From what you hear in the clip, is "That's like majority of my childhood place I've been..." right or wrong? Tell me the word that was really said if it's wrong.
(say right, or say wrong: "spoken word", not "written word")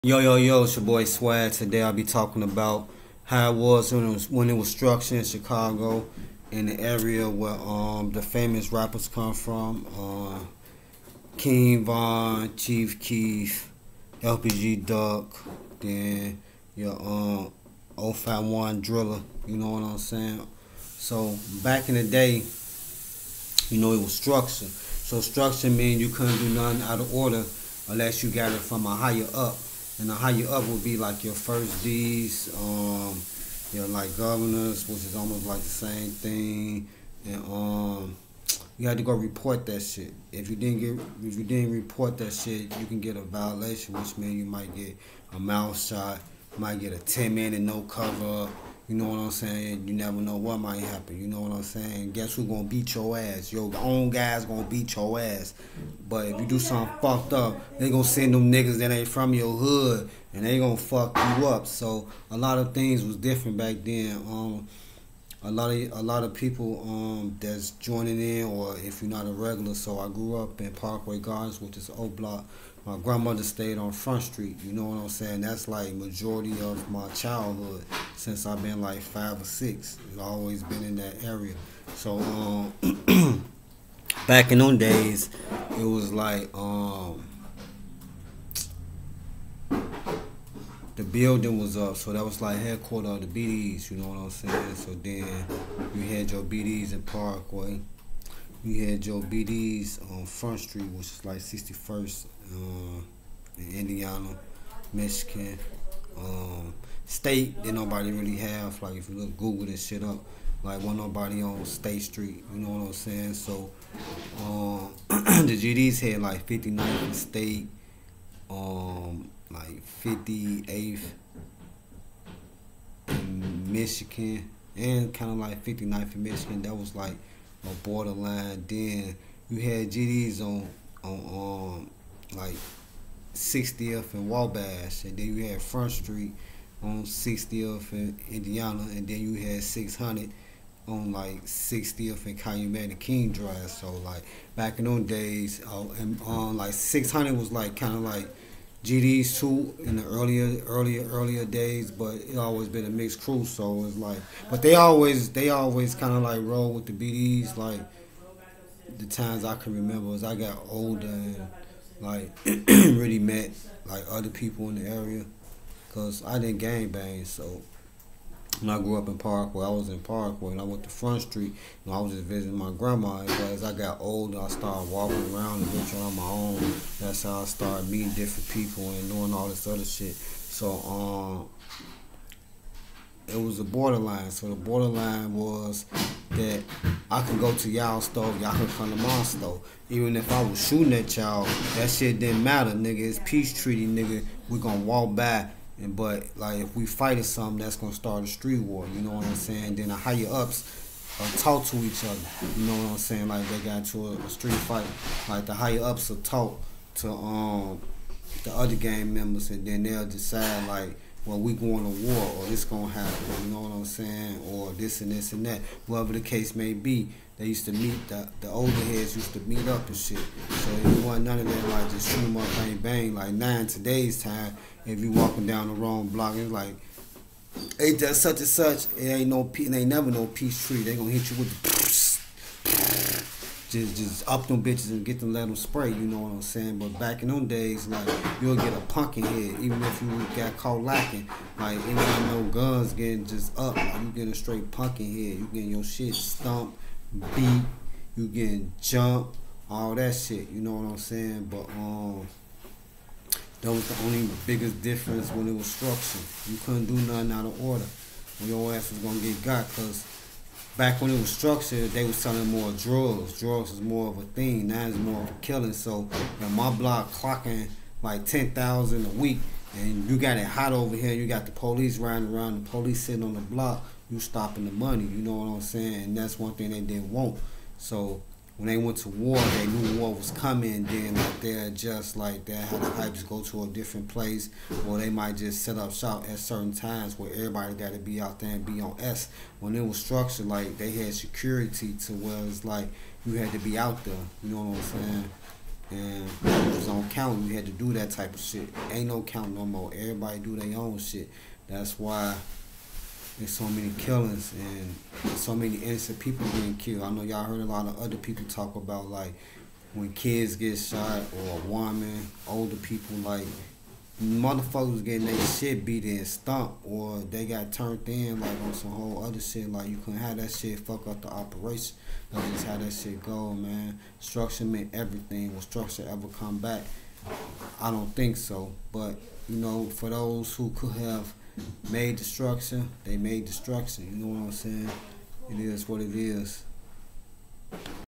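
wrong: "since", not "place".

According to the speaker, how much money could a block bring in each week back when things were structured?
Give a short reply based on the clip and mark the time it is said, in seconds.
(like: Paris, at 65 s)
10,000, at 268 s.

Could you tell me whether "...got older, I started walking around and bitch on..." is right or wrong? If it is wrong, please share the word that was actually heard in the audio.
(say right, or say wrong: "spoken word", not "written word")
right.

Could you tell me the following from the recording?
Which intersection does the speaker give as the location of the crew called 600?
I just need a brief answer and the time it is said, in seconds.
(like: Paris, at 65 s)
60th and Calumet, at 141 s.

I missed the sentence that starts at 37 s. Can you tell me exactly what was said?
And um, you had to go report that shit.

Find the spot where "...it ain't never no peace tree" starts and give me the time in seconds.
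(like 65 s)
229 s.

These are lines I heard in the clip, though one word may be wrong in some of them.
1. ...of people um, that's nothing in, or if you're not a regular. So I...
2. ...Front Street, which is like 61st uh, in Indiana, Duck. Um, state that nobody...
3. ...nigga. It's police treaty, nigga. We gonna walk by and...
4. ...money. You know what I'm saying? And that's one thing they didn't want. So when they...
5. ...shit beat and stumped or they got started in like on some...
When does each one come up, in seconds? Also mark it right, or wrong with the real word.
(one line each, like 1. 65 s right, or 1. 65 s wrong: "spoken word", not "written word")
1. 66 s wrong: "joining", not "nothing"
2. 100 s wrong: "Michigan", not "Duck"
3. 192 s wrong: "peace", not "police"
4. 274 s right
5. 315 s wrong: "turned", not "started".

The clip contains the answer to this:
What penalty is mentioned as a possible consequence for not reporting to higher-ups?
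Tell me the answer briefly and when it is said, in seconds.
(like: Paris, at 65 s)
10 minute no cover, at 46 s.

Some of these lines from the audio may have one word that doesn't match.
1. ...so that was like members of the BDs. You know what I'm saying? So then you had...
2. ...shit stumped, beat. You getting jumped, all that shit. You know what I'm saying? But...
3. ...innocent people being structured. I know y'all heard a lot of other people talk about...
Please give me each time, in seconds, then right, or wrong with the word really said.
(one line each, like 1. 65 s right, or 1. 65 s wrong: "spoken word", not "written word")
1. 91 s wrong: "headquarters", not "members"
2. 245 s right
3. 305 s wrong: "killed", not "structured".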